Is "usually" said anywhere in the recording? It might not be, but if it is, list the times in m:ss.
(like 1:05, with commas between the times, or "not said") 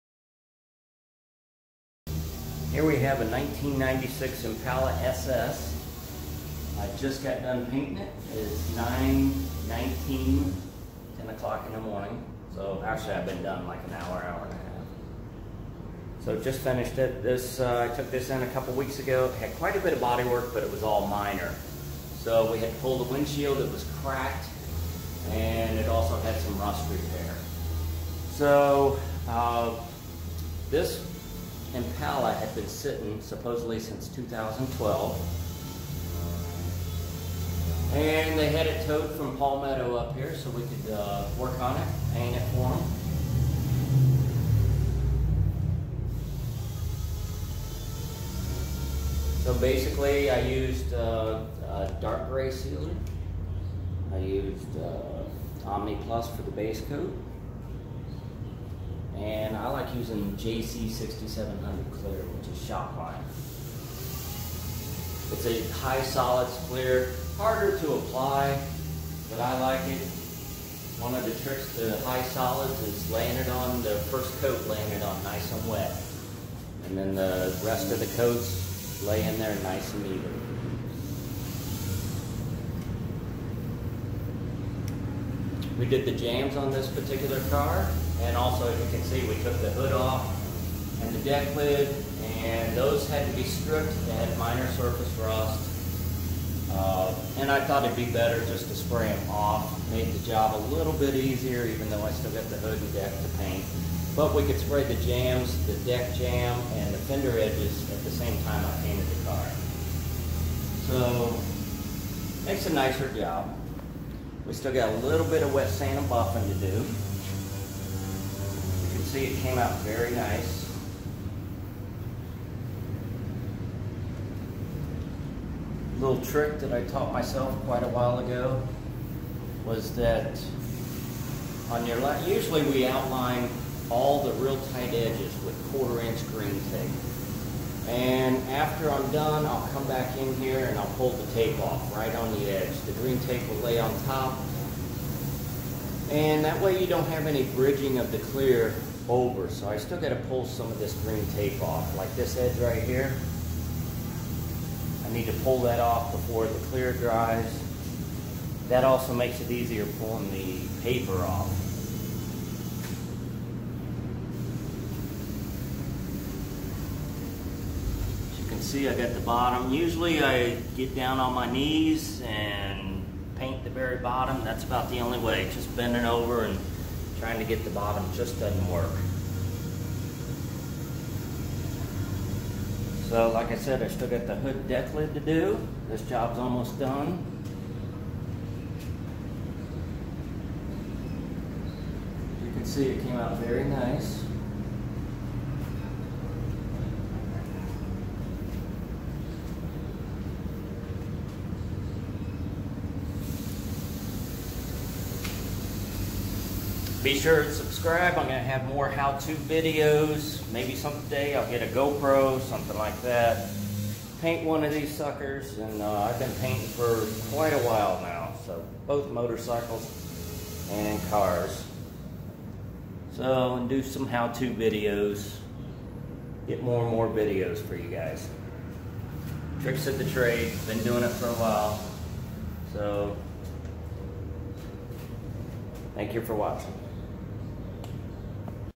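2:12, 2:49.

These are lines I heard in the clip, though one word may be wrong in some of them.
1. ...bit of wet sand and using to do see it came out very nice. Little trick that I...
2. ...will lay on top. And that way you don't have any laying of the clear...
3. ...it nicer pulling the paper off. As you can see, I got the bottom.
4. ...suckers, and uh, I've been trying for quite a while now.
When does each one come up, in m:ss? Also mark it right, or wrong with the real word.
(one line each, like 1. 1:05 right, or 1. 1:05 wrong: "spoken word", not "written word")
1. 1:55 wrong: "buffing", not "using"
2. 2:23 wrong: "bridging", not "laying"
3. 2:39 wrong: "easier", not "nicer"
4. 3:34 wrong: "painting", not "trying".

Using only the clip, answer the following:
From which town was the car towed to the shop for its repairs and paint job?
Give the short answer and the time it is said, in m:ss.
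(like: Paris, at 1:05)
Palmetto, at 0:39.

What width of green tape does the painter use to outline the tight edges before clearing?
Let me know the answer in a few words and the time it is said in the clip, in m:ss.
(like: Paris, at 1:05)
quarter inch, at 2:15.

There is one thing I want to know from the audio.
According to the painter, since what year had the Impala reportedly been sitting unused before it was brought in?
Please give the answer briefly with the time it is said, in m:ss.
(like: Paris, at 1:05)
2012, at 0:34.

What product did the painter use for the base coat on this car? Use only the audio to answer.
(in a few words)
Omni Plus.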